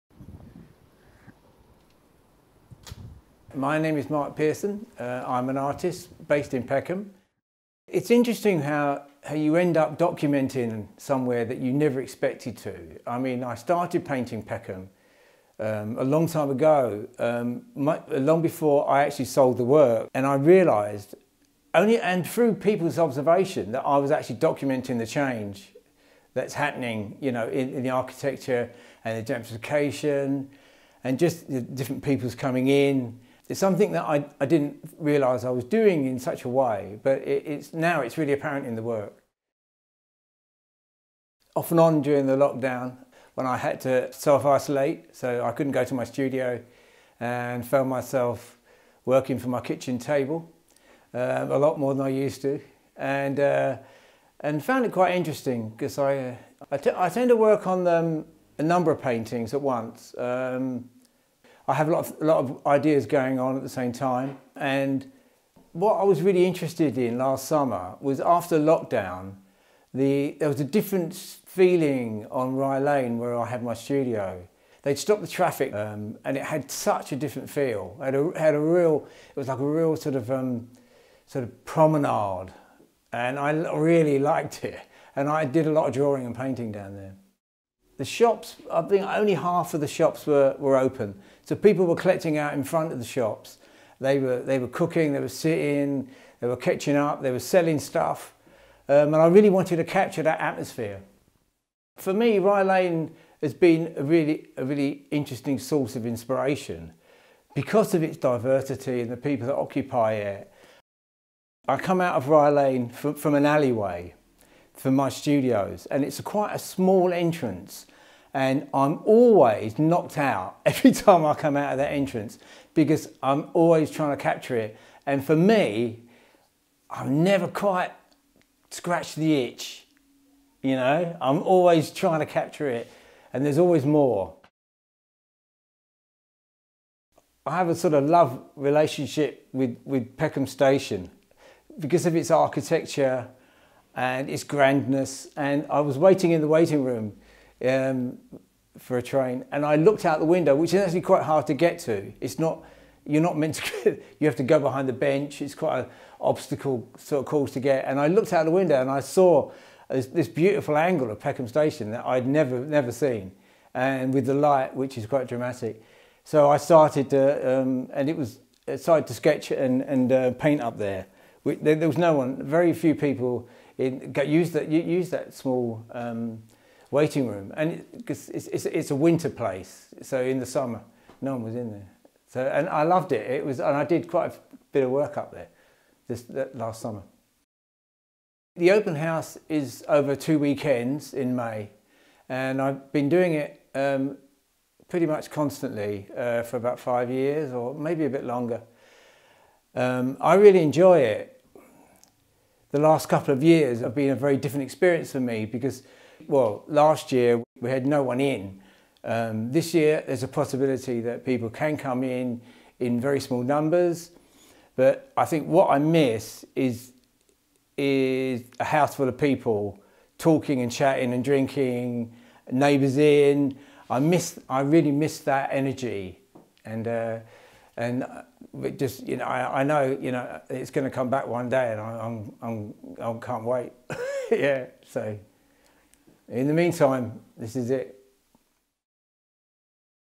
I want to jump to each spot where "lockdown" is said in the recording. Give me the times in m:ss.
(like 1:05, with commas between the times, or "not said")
0:42, 1:08.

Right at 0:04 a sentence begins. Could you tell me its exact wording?
Uh, I'm an artist based in Peckham.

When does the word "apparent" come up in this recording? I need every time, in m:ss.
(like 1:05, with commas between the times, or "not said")
0:38.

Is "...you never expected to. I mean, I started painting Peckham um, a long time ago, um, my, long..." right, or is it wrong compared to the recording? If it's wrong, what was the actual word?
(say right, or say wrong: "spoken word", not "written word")
right.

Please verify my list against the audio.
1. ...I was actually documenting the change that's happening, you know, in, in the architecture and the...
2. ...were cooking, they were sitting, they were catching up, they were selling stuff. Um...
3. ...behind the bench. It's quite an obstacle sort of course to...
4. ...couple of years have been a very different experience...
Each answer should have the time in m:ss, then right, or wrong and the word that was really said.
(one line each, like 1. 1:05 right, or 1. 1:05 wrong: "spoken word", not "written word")
1. 0:23 right
2. 1:34 right
3. 2:34 right
4. 3:23 right.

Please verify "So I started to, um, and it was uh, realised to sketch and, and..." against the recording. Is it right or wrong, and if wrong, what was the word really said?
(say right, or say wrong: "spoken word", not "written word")
wrong: "started", not "realised".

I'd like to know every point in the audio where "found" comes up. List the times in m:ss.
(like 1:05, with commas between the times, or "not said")
0:47, 0:54.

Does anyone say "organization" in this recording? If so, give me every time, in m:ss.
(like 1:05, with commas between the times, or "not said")
not said.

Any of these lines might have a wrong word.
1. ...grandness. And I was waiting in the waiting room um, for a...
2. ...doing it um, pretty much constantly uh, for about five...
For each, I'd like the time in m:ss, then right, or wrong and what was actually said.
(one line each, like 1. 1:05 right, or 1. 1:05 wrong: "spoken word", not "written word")
1. 2:24 right
2. 3:13 right.